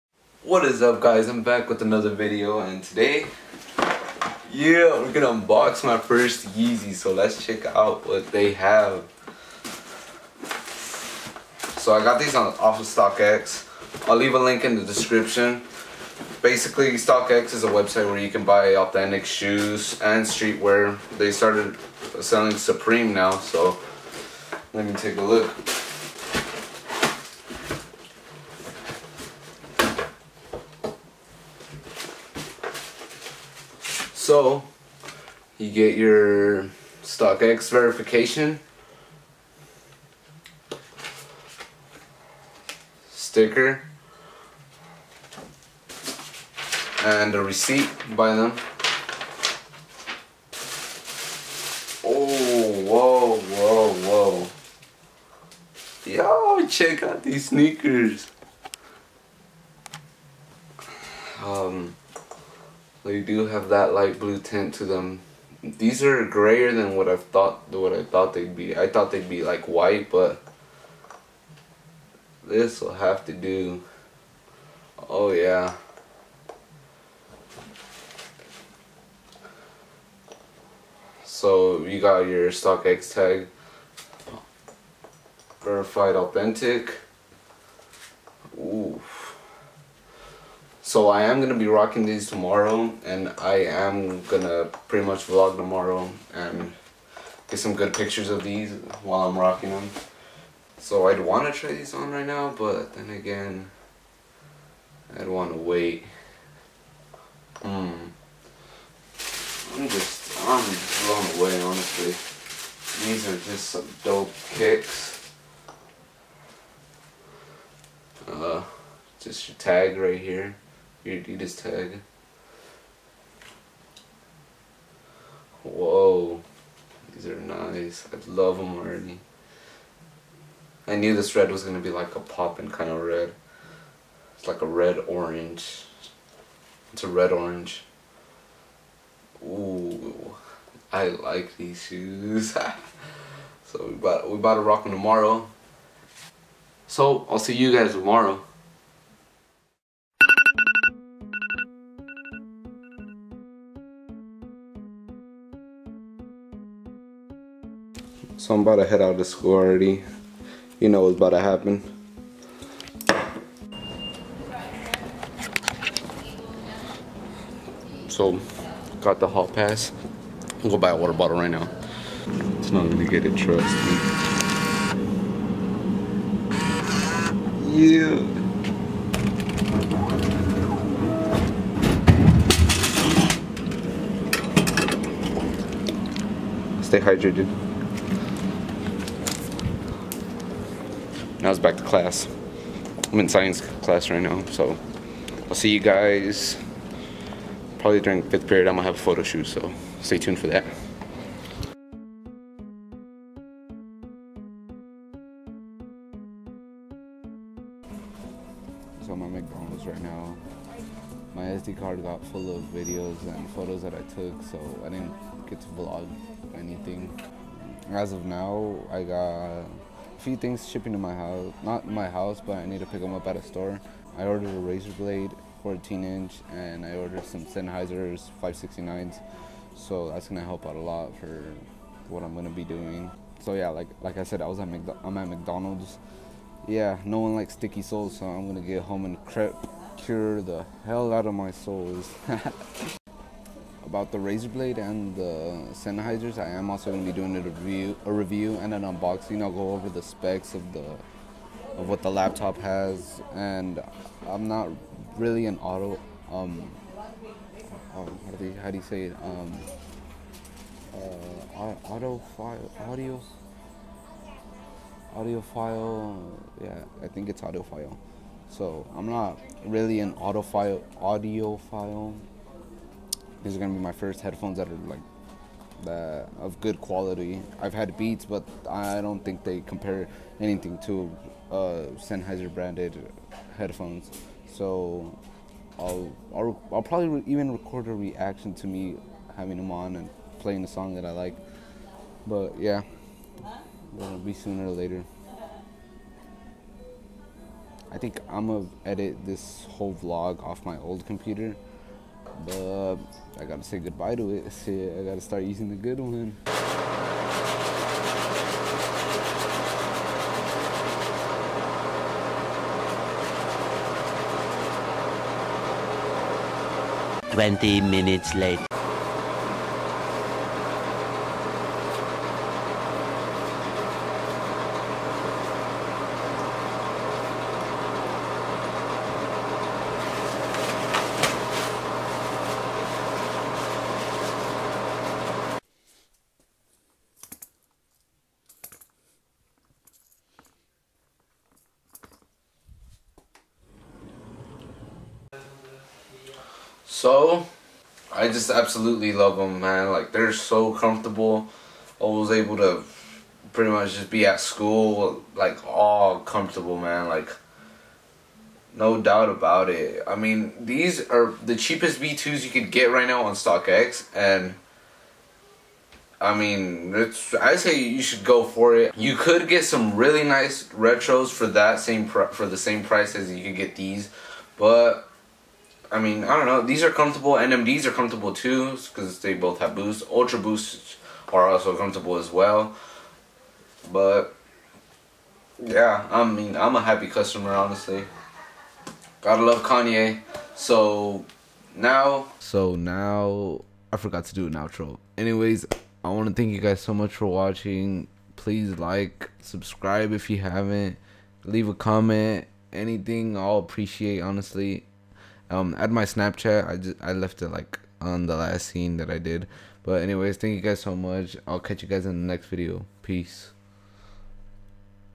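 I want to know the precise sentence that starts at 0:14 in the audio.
I'll leave a link in the description.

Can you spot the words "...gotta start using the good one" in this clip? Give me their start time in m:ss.
5:05.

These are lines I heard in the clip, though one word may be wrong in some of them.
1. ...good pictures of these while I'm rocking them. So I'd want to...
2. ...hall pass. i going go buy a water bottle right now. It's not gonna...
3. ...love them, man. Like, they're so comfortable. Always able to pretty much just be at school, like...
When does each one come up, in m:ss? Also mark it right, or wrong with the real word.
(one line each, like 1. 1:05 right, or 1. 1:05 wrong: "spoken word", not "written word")
1. 1:37 right
2. 2:49 right
3. 5:49 right.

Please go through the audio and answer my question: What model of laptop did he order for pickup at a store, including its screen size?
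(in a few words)
Razer Blade 14 inch.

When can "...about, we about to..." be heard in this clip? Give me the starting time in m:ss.
2:23.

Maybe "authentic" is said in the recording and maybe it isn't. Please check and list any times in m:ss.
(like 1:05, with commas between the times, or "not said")
0:18, 1:26.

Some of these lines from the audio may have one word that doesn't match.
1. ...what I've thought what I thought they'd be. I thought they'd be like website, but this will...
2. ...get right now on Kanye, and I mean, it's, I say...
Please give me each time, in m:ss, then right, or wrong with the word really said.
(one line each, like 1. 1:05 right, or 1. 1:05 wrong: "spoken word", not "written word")
1. 1:06 wrong: "white", not "website"
2. 6:02 wrong: "StockX", not "Kanye".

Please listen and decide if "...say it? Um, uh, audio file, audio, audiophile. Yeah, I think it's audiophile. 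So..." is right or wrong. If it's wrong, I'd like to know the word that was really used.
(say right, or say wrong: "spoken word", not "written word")
right.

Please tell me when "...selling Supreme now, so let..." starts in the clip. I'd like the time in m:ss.
0:22.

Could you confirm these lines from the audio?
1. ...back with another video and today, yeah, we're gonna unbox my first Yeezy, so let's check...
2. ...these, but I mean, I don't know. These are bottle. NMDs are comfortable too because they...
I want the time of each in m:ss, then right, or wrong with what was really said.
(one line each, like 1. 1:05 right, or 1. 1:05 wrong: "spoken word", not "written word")
1. 0:01 right
2. 6:13 wrong: "comfortable", not "bottle".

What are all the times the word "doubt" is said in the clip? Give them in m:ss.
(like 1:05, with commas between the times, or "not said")
5:59.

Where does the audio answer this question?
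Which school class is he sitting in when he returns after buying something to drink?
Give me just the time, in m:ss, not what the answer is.
3:13.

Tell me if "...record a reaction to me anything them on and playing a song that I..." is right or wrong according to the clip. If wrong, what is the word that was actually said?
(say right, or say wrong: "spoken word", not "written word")
wrong: "having", not "anything".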